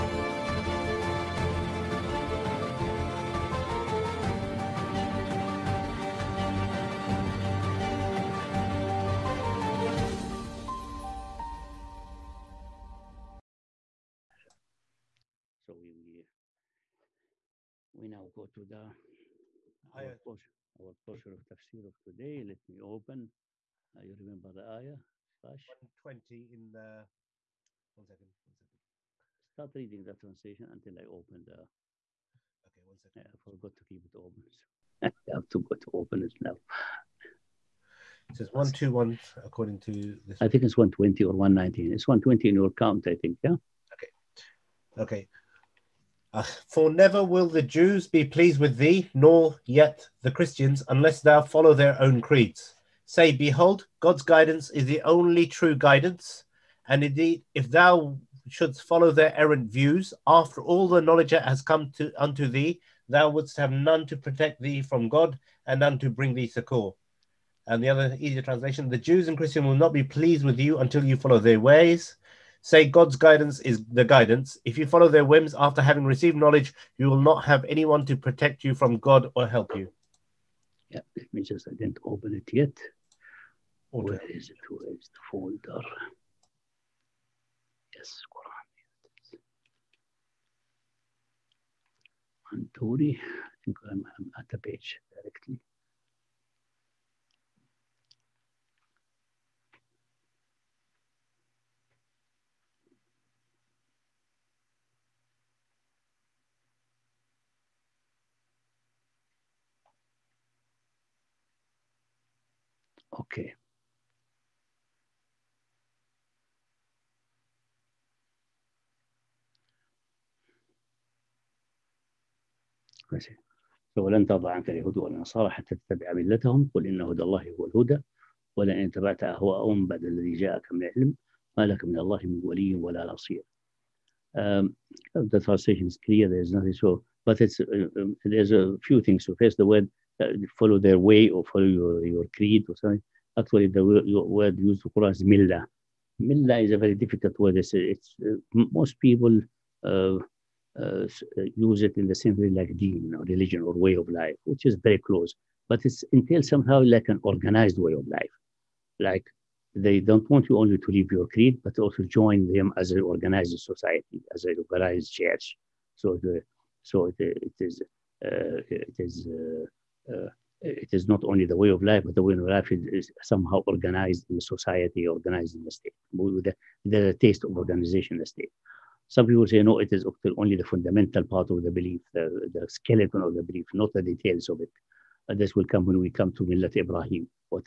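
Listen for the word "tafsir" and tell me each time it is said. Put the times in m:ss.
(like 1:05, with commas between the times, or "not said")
0:21.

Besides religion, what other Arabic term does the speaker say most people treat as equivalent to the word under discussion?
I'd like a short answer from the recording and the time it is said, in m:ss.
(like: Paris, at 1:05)
deen, at 2:32.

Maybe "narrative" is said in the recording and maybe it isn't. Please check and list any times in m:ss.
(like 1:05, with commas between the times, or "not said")
not said.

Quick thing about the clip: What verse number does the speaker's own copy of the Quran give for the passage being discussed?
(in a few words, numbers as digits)
121.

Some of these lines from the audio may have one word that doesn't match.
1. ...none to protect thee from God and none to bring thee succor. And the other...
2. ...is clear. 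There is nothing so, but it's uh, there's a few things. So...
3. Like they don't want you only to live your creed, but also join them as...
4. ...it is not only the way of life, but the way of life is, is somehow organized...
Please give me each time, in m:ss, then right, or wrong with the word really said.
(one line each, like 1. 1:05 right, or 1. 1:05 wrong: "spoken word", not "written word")
1. 1:03 right
2. 2:15 right
3. 2:38 right
4. 2:50 right.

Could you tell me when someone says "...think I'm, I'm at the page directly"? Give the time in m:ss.
1:33.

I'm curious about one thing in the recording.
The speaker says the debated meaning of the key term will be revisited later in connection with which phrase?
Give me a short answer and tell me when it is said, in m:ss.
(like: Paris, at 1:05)
Millat Ibrahim, at 3:06.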